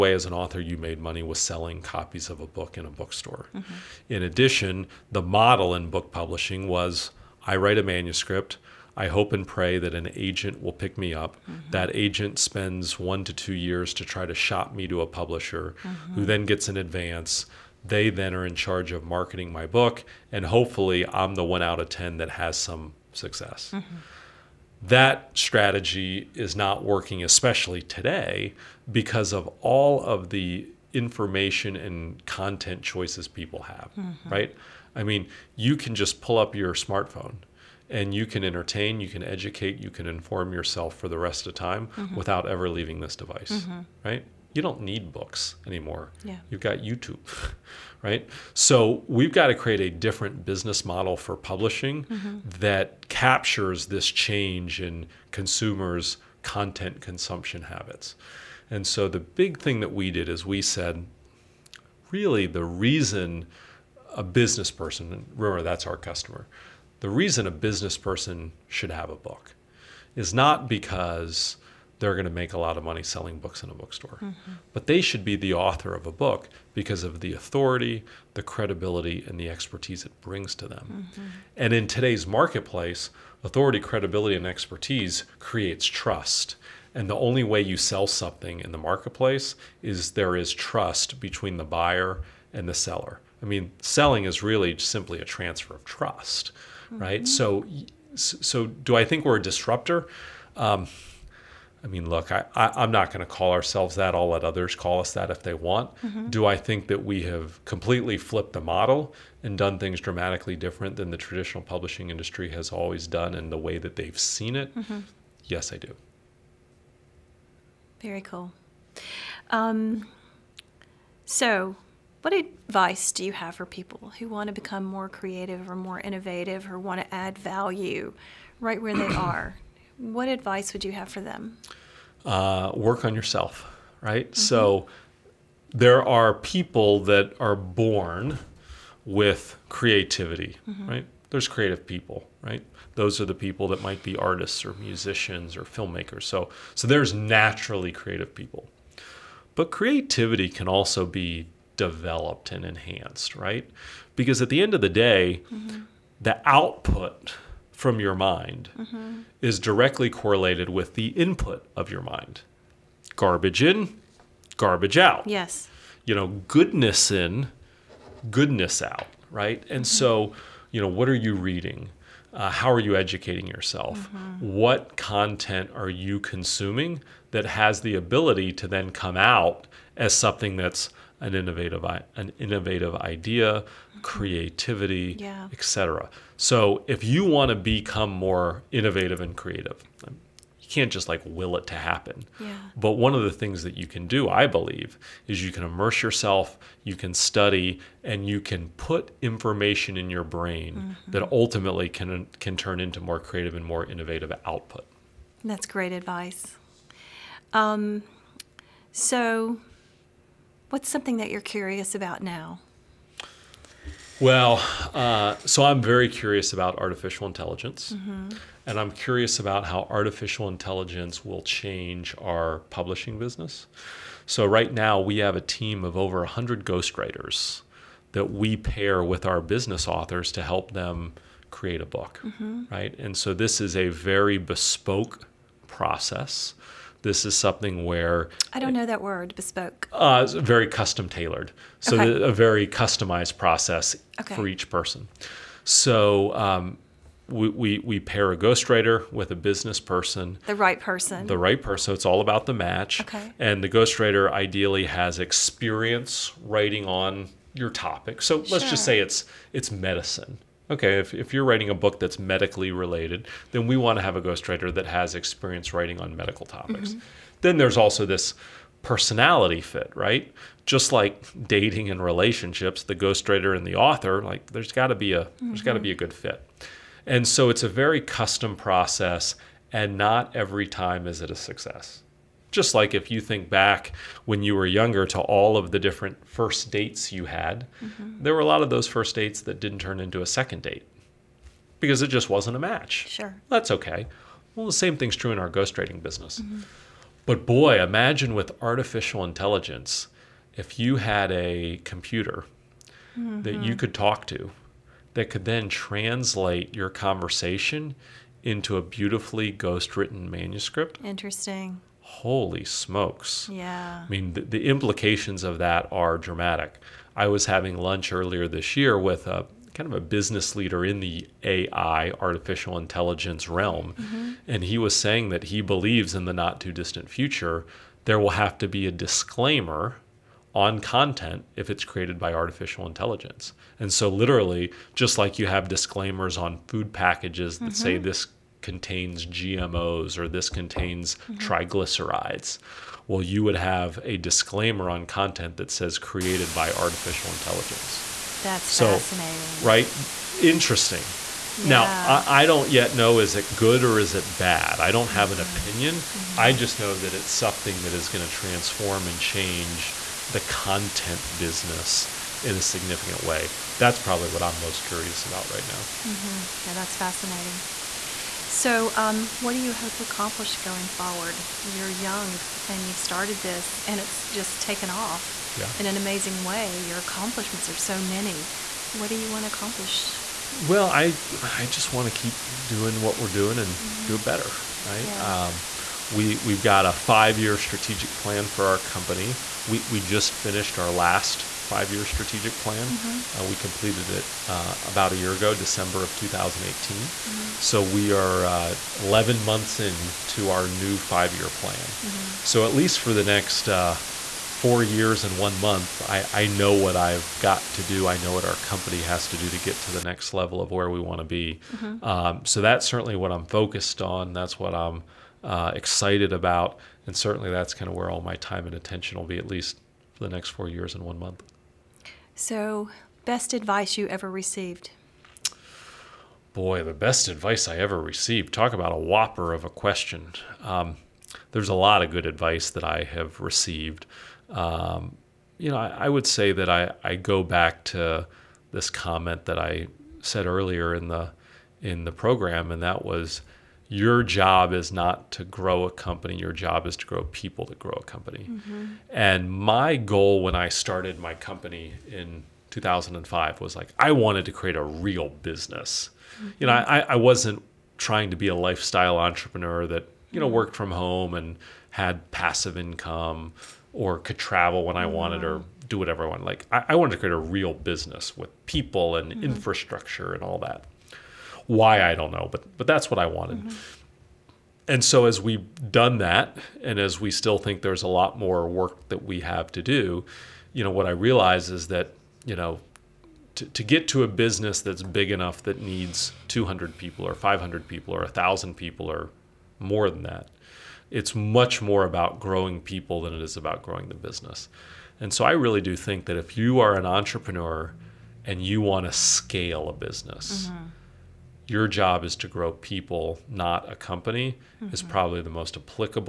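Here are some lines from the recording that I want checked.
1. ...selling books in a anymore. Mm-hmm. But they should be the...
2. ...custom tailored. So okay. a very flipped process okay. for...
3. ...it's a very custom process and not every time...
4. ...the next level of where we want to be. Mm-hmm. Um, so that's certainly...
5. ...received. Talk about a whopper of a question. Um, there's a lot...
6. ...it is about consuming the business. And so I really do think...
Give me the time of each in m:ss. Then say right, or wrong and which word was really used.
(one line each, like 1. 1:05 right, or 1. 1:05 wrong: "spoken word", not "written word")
1. 1:13 wrong: "bookstore", not "anymore"
2. 4:00 wrong: "customized", not "flipped"
3. 4:37 right
4. 6:49 right
5. 7:08 right
6. 8:13 wrong: "growing", not "consuming".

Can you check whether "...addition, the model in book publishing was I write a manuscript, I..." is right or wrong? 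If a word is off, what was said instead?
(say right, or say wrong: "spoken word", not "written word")
right.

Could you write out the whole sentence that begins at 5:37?
say this contains GMOs or this contains mm-hmm.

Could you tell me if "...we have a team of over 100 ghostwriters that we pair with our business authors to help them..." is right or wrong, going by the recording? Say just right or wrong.
right.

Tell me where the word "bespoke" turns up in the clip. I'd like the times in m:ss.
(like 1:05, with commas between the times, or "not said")
3:54, 3:59.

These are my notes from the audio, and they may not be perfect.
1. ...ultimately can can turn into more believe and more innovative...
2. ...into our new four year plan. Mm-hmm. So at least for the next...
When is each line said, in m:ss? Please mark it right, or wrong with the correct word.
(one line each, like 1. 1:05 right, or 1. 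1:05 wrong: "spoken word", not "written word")
1. 3:21 wrong: "creative", not "believe"
2. 6:39 wrong: "five", not "four".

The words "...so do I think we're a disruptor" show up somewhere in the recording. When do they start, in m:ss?
1:38.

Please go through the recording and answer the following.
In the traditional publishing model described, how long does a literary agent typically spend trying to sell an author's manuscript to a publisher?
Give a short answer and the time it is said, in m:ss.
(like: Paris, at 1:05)
1 to 2 years, at 0:12.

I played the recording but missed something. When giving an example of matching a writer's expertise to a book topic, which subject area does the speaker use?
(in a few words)
Medicine.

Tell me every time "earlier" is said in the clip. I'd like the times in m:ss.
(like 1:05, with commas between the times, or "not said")
5:18, 7:20.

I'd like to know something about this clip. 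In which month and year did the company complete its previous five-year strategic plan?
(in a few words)
December 2018.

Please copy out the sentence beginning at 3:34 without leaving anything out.
Well, uh, so I'm very curious about artificial intelligence, mm-hmm.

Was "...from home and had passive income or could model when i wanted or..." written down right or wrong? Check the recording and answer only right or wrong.
wrong.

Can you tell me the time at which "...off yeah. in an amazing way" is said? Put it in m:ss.
6:14.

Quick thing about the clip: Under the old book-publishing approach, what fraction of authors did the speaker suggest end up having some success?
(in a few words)
1 out of 10.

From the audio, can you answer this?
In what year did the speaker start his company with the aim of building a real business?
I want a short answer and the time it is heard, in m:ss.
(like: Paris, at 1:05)
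2005, at 7:32.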